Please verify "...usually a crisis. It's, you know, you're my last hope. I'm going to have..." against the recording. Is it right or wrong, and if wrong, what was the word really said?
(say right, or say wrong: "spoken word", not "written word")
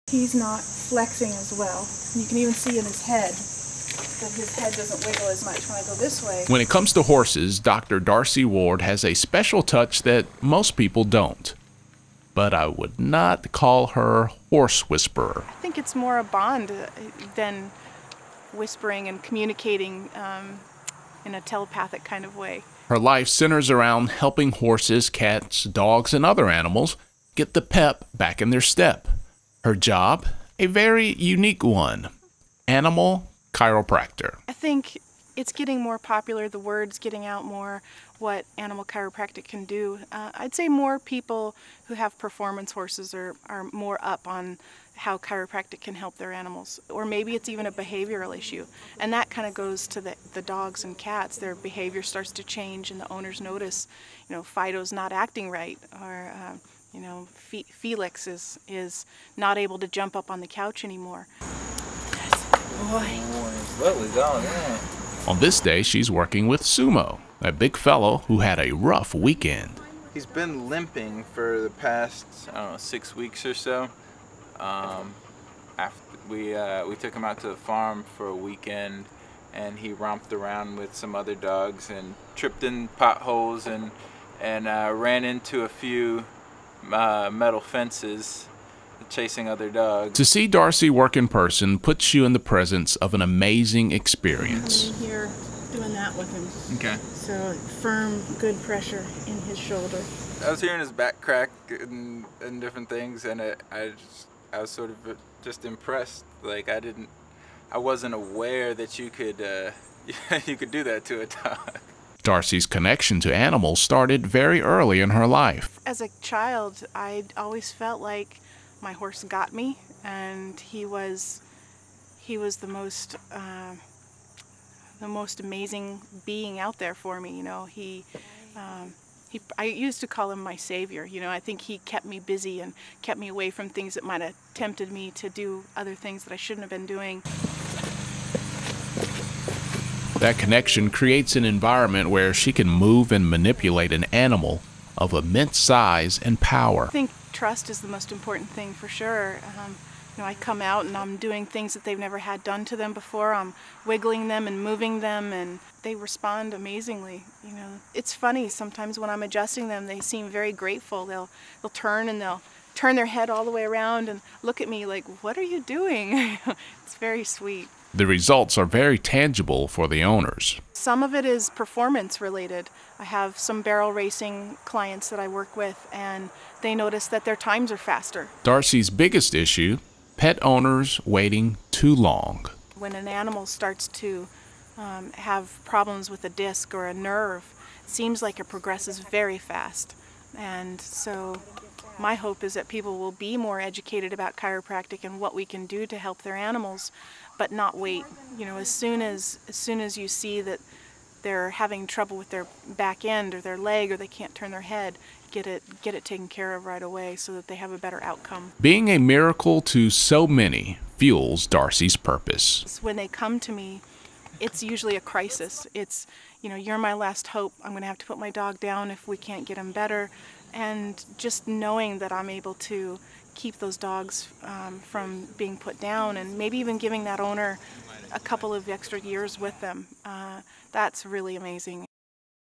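right.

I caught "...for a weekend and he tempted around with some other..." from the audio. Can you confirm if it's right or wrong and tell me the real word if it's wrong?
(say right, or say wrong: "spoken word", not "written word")
wrong: "romped", not "tempted".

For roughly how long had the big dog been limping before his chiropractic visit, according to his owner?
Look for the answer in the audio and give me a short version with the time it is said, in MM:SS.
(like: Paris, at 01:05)
6 weeks, at 01:12.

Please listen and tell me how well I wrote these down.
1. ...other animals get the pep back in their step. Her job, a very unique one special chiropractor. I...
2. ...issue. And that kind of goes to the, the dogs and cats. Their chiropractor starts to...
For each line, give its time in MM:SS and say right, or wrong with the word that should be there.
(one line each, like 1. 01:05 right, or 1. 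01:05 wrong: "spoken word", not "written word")
1. 00:26 wrong: "animal", not "special"
2. 00:48 wrong: "behavior", not "chiropractor".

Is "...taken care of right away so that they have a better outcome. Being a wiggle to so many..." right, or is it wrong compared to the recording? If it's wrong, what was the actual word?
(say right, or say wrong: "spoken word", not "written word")
wrong: "miracle", not "wiggle".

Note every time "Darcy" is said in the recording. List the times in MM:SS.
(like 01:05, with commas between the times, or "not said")
00:07, 01:30, 01:52, 02:58, 03:31.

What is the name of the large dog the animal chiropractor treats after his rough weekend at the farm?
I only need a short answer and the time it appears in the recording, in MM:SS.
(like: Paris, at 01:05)
Sumo, at 01:06.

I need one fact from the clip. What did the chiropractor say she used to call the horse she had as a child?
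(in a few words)
my savior.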